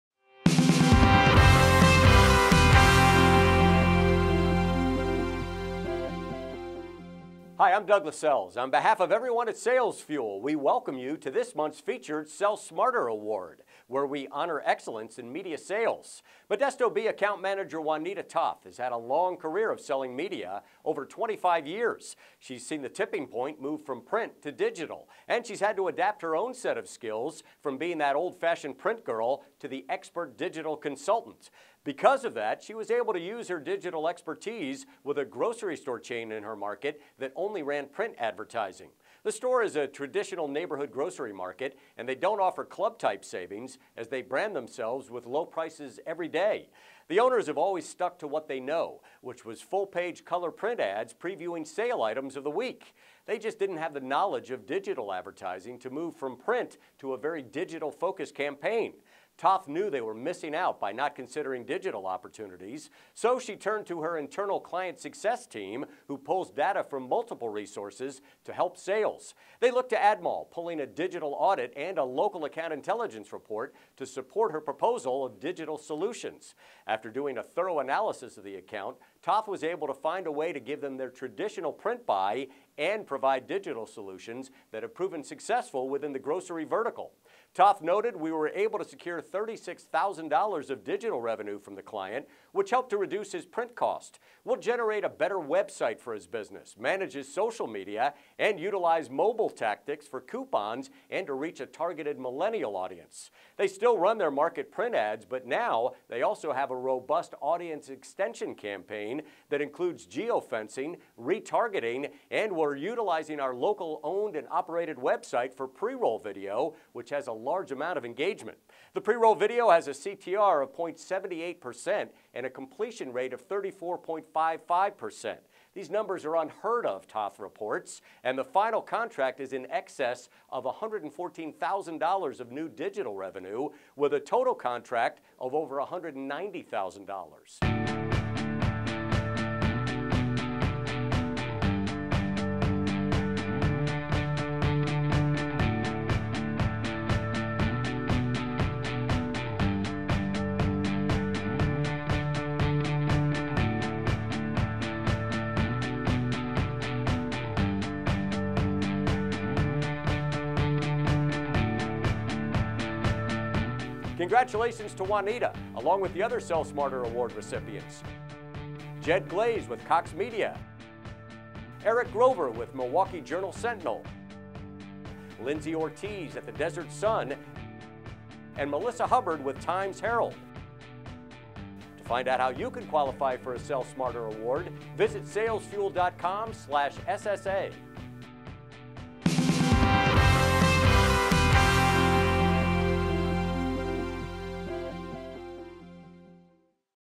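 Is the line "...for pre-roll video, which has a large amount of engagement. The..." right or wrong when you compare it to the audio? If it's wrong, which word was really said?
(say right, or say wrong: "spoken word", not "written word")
right.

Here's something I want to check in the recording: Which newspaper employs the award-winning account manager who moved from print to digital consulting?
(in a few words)
Modesto Bee.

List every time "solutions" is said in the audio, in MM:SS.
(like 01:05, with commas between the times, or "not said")
01:15, 01:23.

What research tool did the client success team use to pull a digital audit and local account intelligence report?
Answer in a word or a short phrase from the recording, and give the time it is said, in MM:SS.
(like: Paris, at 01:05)
AdMall, at 01:09.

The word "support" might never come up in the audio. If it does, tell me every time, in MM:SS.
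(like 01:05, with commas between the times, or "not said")
01:14.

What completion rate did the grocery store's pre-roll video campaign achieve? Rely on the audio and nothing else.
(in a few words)
34.55%.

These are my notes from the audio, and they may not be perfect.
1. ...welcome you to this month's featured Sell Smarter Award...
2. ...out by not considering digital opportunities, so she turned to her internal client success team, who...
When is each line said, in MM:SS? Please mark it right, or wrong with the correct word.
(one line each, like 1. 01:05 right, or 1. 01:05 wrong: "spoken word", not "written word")
1. 00:10 right
2. 01:00 right.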